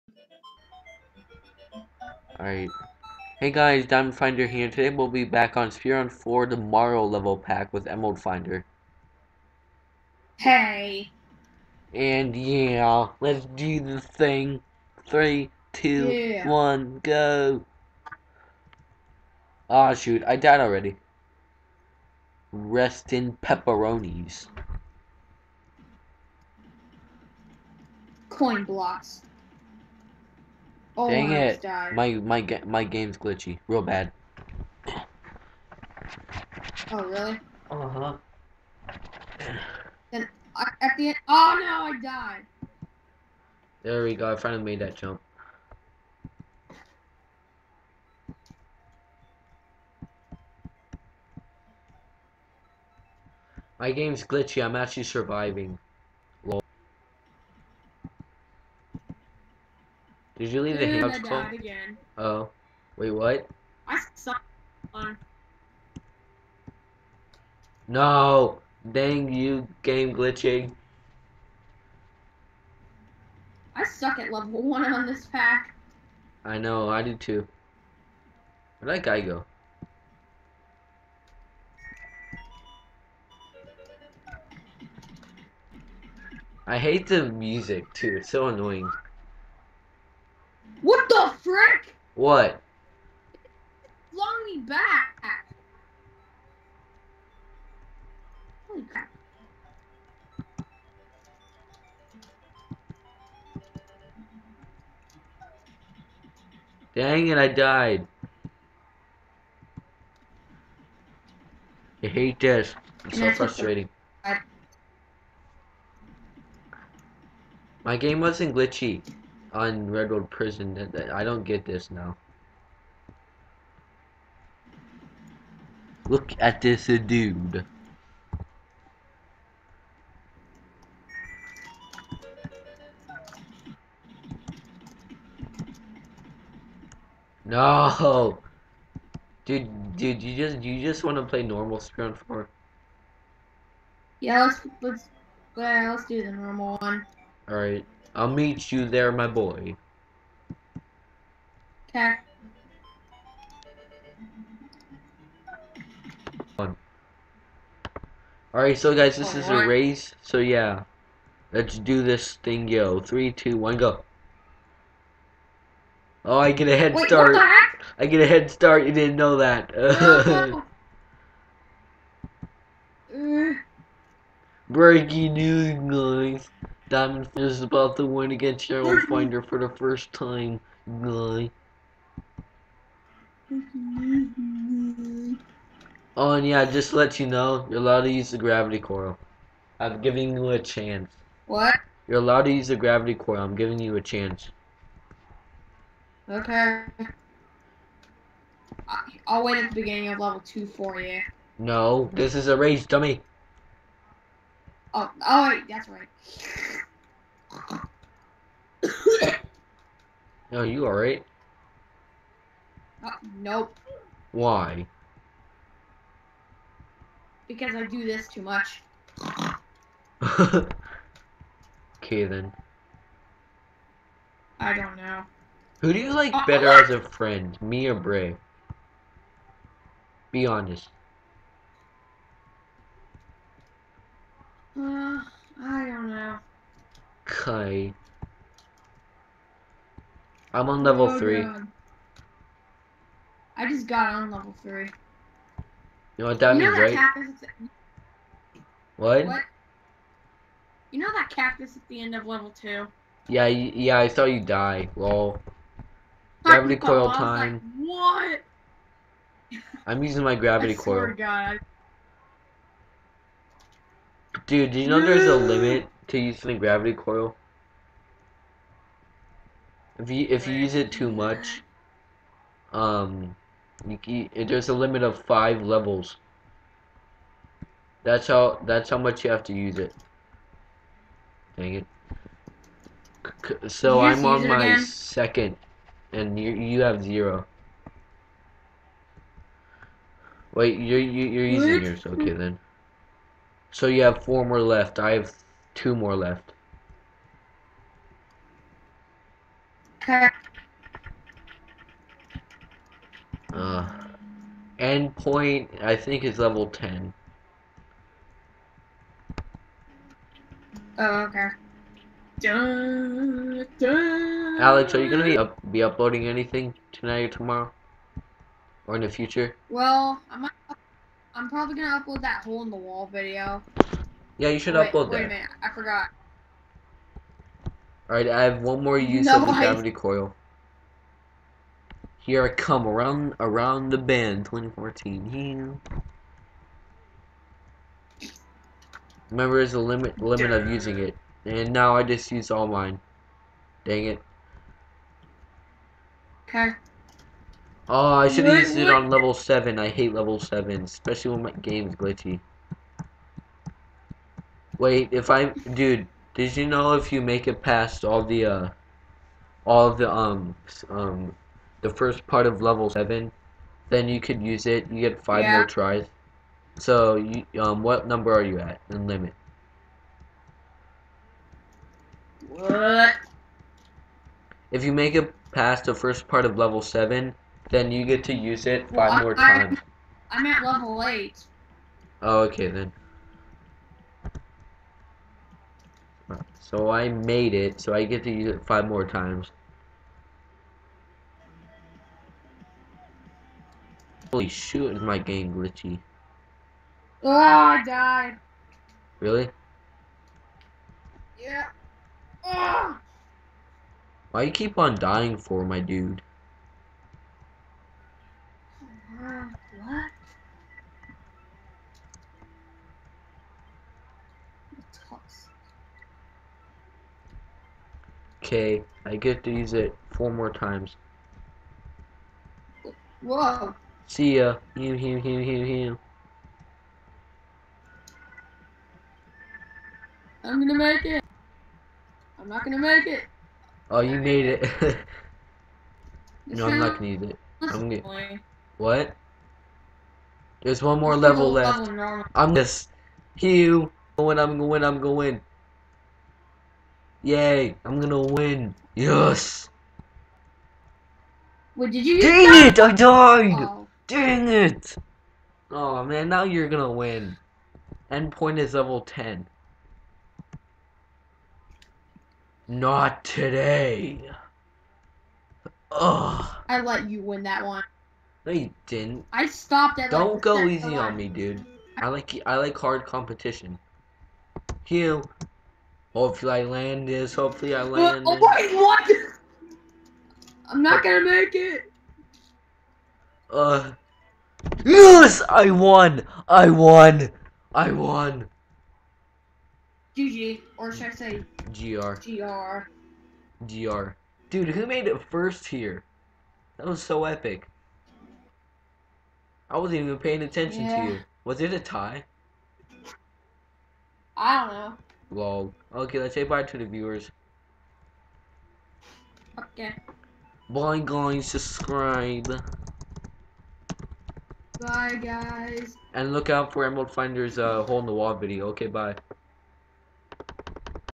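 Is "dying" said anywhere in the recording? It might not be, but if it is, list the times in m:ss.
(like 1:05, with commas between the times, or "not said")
6:44.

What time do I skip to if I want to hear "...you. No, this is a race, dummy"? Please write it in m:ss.
3:20.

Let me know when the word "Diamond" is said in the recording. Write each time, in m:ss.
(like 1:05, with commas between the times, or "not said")
0:03, 2:56.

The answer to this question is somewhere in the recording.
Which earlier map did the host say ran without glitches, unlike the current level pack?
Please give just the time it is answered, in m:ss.
1:59.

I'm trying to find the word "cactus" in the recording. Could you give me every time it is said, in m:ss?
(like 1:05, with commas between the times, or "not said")
4:06, 4:11.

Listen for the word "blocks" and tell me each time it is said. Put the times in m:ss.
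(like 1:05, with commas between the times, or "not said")
0:28.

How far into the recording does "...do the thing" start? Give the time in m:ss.
0:13.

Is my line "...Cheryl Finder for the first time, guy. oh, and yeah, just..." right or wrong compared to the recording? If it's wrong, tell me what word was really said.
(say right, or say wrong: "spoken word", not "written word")
right.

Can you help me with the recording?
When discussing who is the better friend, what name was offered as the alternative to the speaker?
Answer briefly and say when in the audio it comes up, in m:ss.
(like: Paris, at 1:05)
Bray, at 3:47.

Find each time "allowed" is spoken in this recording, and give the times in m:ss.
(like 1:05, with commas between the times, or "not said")
3:07, 3:12.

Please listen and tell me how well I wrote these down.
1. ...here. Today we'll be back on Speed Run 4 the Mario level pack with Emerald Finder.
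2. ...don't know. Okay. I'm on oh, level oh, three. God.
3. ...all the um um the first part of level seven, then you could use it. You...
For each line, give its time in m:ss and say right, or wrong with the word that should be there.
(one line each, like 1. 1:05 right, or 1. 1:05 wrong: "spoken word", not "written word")
1. 0:04 right
2. 3:55 right
3. 5:59 right.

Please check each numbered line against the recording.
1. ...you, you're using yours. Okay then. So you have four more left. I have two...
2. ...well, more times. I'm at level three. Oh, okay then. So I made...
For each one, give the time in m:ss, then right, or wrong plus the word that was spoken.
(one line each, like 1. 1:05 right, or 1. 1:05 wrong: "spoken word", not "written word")
1. 4:50 right
2. 6:19 wrong: "eight", not "three".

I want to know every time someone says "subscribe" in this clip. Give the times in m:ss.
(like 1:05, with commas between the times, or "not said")
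8:31.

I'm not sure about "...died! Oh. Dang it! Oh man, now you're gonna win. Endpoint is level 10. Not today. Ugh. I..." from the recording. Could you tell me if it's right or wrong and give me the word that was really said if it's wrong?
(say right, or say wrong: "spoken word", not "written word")
right.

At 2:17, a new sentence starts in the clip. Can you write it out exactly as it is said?
No, dude, dude, you just you just want to play normal Scrum Four.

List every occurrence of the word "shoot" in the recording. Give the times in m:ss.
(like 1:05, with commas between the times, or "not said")
0:19, 6:34.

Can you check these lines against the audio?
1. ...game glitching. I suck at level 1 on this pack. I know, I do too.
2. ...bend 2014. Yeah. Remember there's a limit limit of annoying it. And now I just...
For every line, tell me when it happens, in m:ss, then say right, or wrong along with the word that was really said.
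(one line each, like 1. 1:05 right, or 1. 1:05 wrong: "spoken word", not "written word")
1. 1:09 right
2. 5:33 wrong: "using", not "annoying".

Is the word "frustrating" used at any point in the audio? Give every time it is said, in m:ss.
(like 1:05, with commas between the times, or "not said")
1:53.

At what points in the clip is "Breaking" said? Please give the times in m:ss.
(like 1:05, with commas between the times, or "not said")
2:54.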